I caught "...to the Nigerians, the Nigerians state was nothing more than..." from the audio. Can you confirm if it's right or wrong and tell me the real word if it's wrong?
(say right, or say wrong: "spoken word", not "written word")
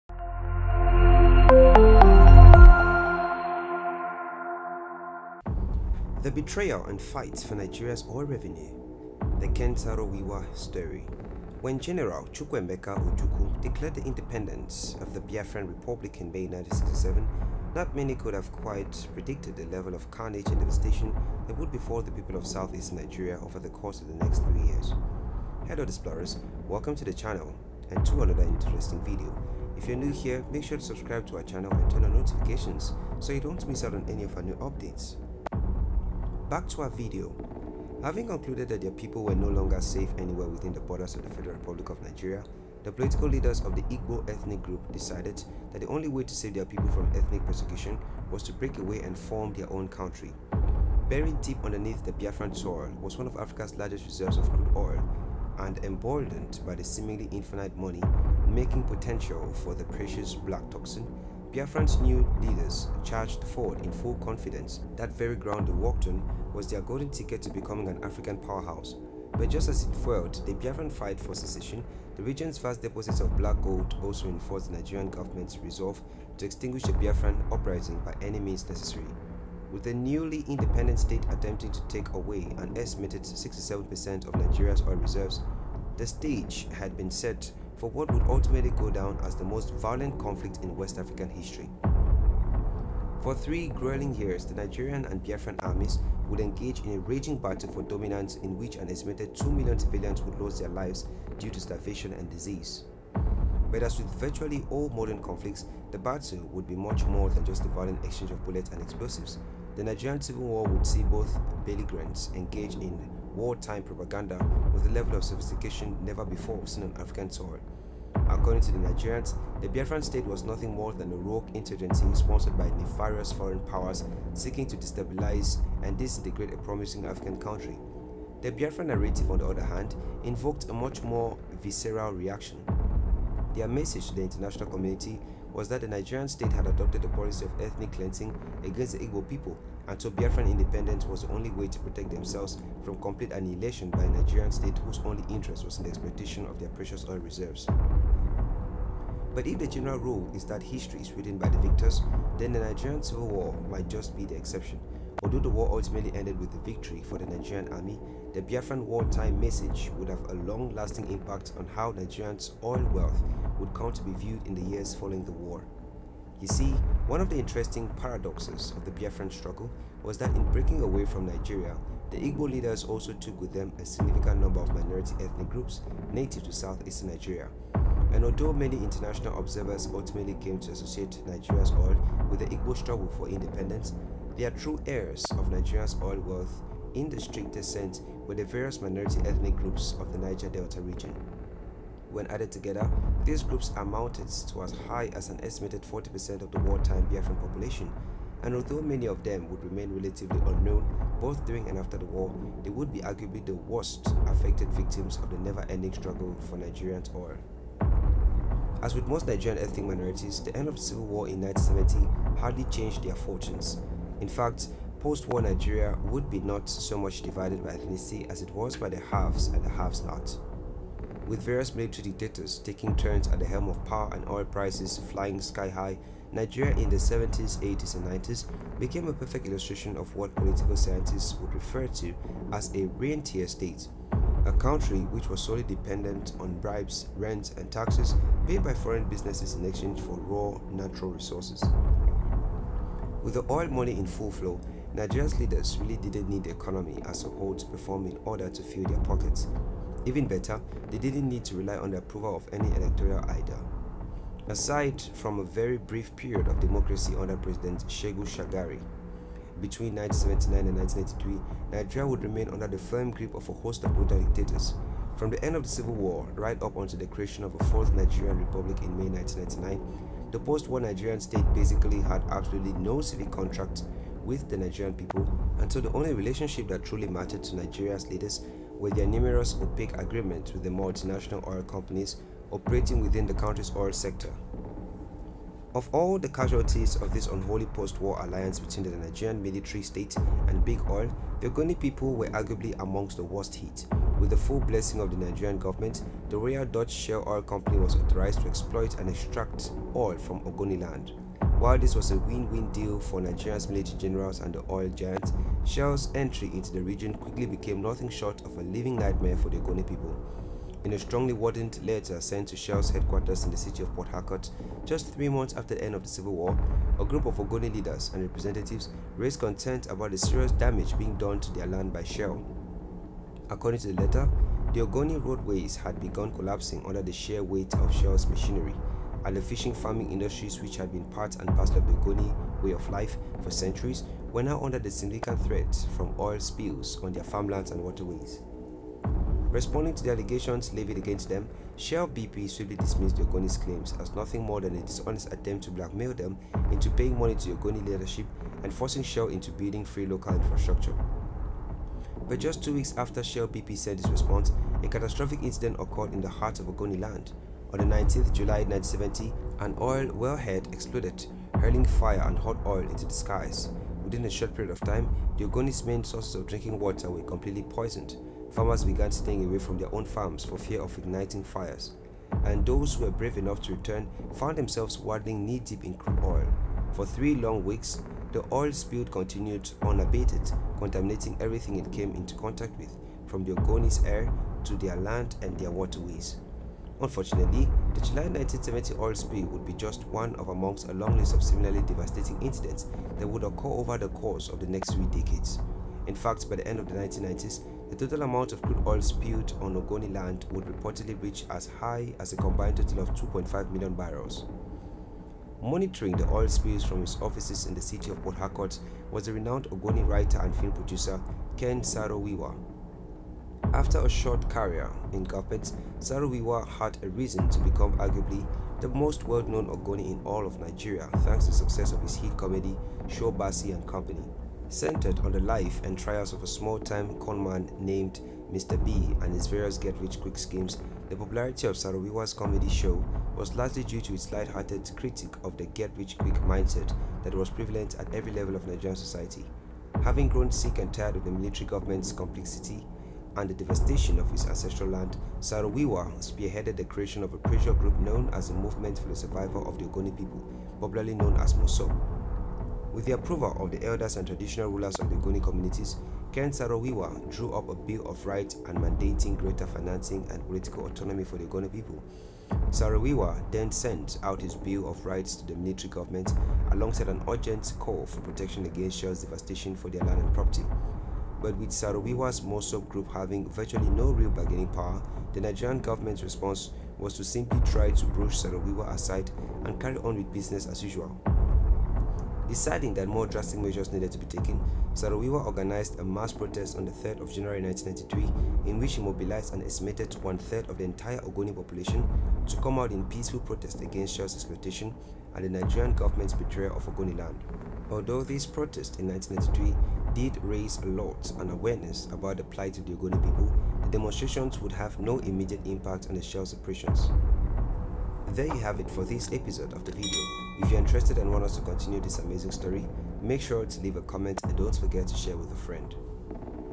wrong: "Biafran", not "Nigerians".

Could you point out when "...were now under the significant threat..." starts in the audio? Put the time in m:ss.
5:34.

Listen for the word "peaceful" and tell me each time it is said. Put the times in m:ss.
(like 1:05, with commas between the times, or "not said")
8:13.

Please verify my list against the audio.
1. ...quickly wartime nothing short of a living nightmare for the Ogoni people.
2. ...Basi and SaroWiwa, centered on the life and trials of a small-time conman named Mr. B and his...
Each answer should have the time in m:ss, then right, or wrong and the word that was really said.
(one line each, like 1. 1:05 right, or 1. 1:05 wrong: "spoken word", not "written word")
1. 5:07 wrong: "became", not "wartime"
2. 7:03 wrong: "Company", not "SaroWiwa".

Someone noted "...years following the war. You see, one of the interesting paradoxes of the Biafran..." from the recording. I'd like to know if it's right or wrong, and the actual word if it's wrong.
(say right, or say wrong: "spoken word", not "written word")
right.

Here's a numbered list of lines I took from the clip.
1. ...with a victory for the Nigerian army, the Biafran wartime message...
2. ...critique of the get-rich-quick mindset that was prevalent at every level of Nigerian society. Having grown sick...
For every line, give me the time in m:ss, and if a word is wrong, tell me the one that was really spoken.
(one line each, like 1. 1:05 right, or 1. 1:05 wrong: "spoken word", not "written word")
1. 2:36 right
2. 7:14 right.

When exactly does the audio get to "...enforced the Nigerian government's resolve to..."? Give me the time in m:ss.
1:14.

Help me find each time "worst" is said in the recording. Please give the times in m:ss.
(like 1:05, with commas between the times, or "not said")
3:23, 4:53.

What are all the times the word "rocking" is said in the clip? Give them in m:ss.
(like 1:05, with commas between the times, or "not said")
not said.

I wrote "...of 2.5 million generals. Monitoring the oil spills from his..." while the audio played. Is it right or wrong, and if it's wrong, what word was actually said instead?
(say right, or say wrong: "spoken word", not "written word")
wrong: "barrels", not "generals".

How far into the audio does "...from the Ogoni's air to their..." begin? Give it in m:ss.
6:23.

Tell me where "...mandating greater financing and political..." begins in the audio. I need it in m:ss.
7:38.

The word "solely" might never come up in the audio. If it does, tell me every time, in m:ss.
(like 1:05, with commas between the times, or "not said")
3:55.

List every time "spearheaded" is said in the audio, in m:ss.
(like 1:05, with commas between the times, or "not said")
7:26.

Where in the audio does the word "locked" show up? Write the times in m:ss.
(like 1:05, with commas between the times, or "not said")
not said.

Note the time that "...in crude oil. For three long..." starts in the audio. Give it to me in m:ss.
6:15.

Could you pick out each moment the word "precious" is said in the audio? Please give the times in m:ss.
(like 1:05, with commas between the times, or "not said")
0:59, 2:26.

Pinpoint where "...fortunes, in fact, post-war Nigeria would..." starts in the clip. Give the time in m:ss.
3:33.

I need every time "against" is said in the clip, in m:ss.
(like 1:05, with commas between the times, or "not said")
2:18, 5:40, 7:48, 8:13.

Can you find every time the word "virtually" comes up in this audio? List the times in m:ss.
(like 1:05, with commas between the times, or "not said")
1:44, 7:53.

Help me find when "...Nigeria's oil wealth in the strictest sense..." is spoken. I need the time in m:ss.
3:05.